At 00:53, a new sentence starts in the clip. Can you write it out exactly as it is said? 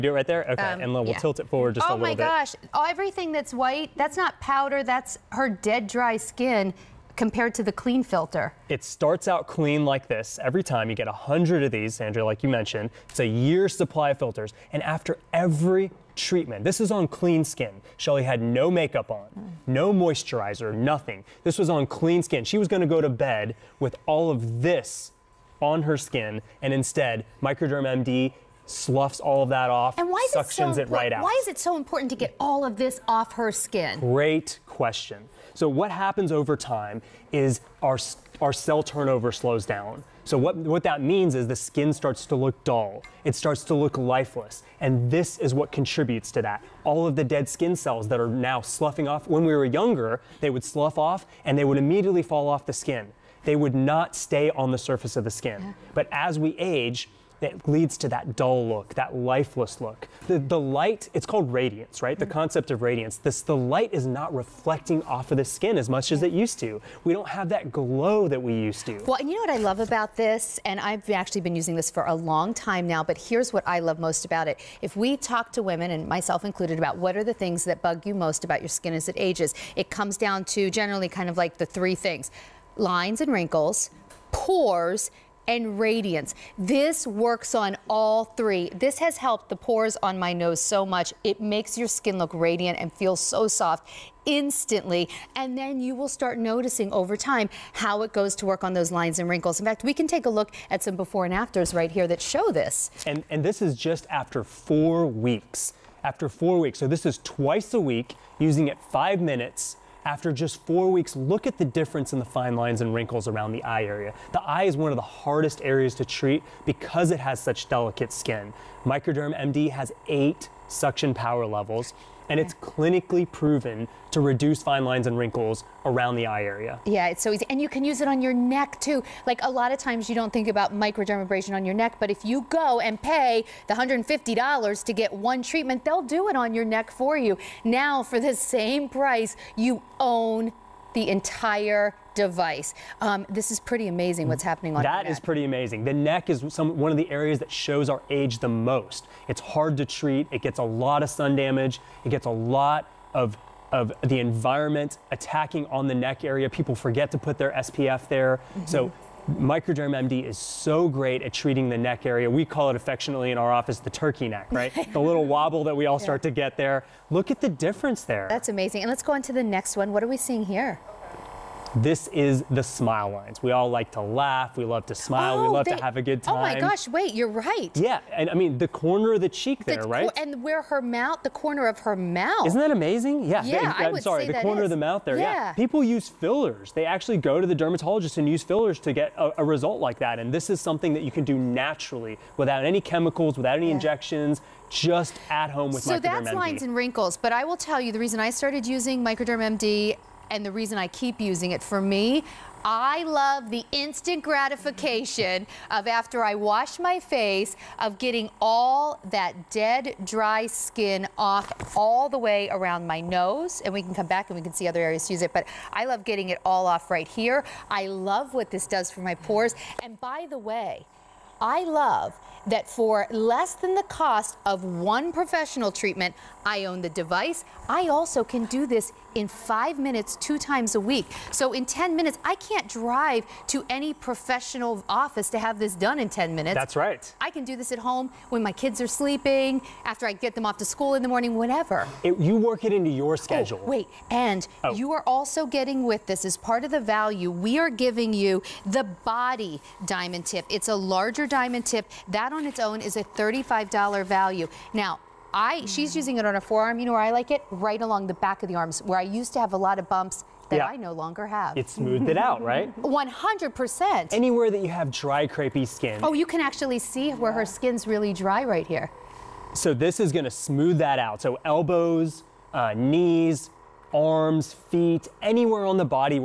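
They would not stay on the surface of the skin.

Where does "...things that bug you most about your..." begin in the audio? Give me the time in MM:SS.
01:17.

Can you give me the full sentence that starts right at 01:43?
And, and this is just after four weeks.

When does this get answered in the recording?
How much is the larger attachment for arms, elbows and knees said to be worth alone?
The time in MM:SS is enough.
04:13.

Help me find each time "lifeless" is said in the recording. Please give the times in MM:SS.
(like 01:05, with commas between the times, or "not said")
00:43, 00:59.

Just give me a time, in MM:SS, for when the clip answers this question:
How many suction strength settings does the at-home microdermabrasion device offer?
02:00.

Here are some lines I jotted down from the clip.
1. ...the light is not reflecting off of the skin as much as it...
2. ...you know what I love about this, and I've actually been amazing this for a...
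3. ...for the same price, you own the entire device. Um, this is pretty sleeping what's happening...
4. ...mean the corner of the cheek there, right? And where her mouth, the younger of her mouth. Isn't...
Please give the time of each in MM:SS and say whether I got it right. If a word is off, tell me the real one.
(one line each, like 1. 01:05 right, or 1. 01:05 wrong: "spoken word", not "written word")
1. 01:03 right
2. 01:09 wrong: "using", not "amazing"
3. 02:18 wrong: "amazing", not "sleeping"
4. 02:58 wrong: "corner", not "younger".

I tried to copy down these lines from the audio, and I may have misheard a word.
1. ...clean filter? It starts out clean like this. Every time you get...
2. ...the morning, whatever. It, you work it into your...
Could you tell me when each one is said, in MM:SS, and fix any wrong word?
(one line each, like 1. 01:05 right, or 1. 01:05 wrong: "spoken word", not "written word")
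1. 00:07 right
2. 04:01 right.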